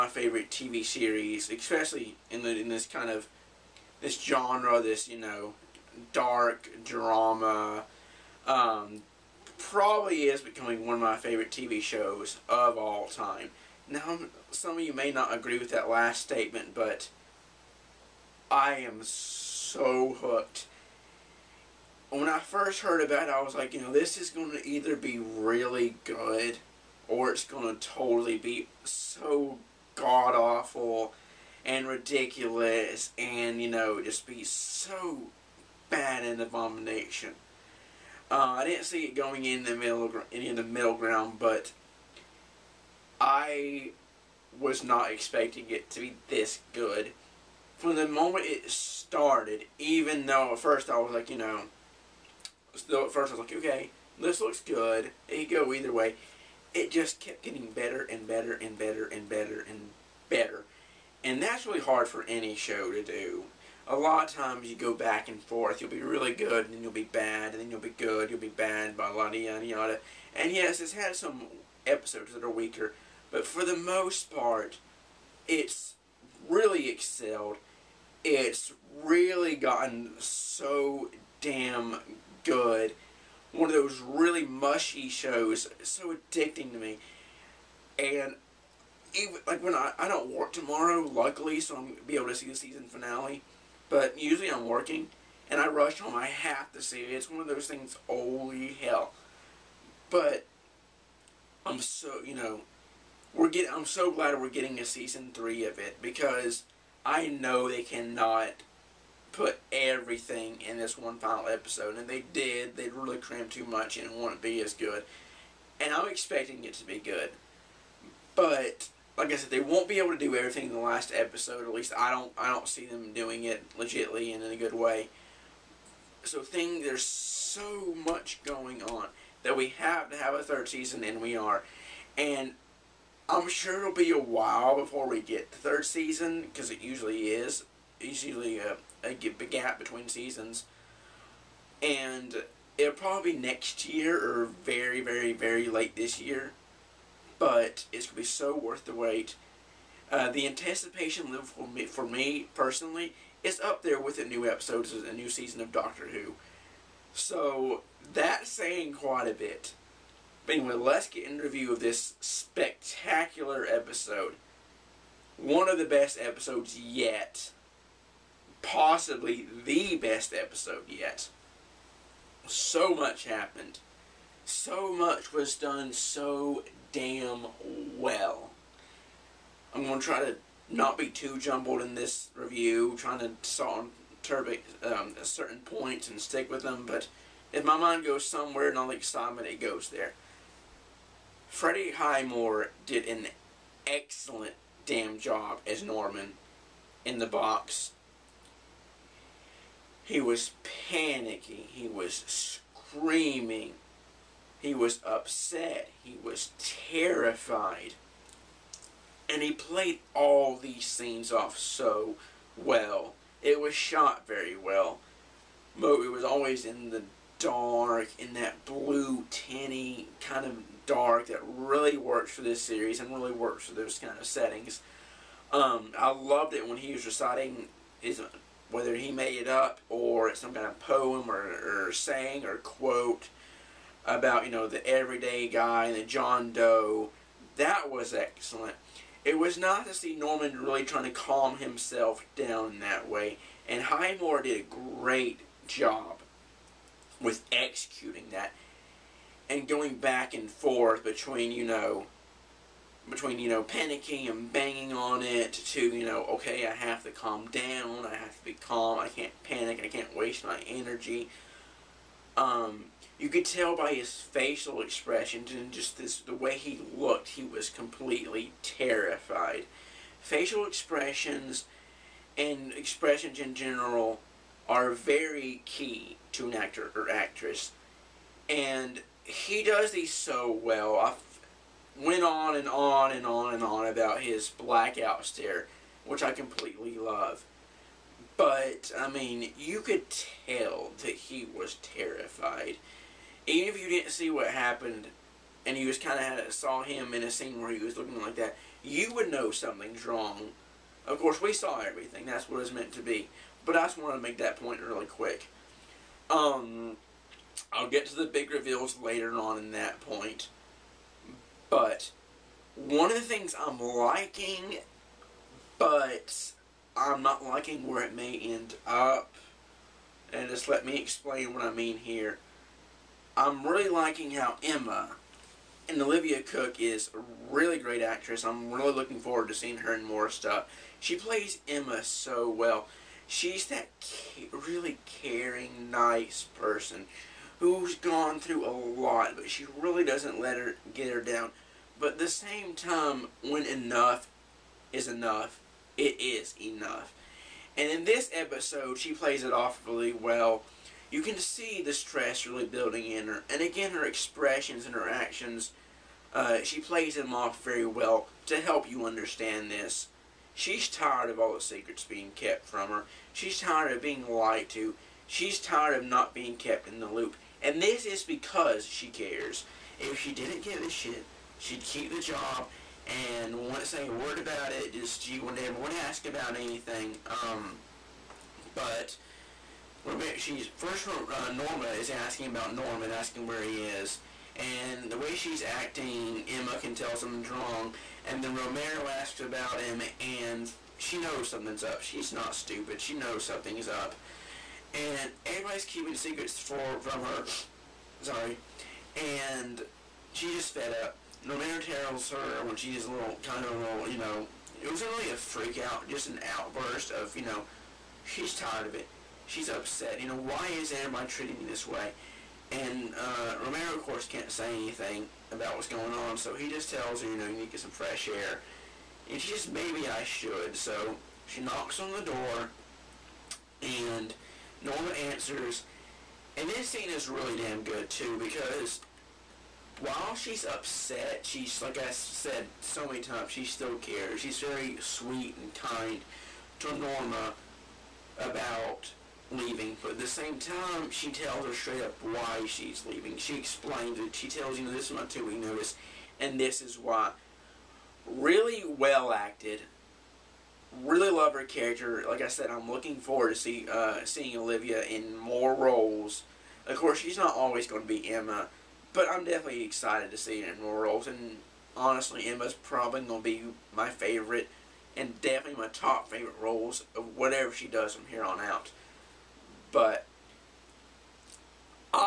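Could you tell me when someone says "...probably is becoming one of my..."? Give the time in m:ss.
0:09.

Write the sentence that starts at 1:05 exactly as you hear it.
You'll be really good, and then you'll be bad, and then you'll be good, you'll be bad, blah, blah, yada, yada.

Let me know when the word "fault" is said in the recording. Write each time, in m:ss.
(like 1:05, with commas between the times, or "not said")
not said.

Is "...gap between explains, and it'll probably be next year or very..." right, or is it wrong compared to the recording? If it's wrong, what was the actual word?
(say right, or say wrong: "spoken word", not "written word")
wrong: "seasons", not "explains".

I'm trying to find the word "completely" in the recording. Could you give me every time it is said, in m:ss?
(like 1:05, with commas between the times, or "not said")
4:27, 4:46.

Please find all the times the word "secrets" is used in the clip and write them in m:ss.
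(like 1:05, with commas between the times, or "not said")
6:01, 6:36.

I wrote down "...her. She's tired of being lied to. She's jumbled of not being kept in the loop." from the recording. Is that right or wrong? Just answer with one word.
wrong.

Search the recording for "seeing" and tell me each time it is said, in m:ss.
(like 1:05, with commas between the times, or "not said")
5:29, 7:34.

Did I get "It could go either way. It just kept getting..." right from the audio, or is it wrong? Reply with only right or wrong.
right.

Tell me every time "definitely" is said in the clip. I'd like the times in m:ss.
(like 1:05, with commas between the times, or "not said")
7:39, 7:45.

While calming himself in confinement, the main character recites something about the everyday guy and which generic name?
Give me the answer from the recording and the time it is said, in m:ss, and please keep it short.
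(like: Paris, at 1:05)
John Doe, at 3:56.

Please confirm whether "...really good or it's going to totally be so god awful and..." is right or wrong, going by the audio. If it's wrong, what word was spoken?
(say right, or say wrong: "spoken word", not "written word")
right.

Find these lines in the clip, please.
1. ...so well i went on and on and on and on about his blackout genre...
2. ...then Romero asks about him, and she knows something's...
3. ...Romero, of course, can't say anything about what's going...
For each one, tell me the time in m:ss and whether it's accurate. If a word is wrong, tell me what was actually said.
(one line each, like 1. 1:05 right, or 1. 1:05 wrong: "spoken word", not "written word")
1. 4:40 wrong: "stare", not "genre"
2. 6:28 right
3. 6:53 right.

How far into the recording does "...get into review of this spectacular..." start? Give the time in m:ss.
2:41.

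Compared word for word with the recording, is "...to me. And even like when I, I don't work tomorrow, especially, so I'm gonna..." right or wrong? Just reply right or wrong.
wrong.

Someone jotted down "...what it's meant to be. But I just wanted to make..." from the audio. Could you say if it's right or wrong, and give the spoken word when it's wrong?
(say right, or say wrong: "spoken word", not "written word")
right.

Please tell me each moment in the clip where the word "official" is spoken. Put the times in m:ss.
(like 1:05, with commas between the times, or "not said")
not said.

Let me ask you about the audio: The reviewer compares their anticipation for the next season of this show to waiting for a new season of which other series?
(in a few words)
Doctor Who.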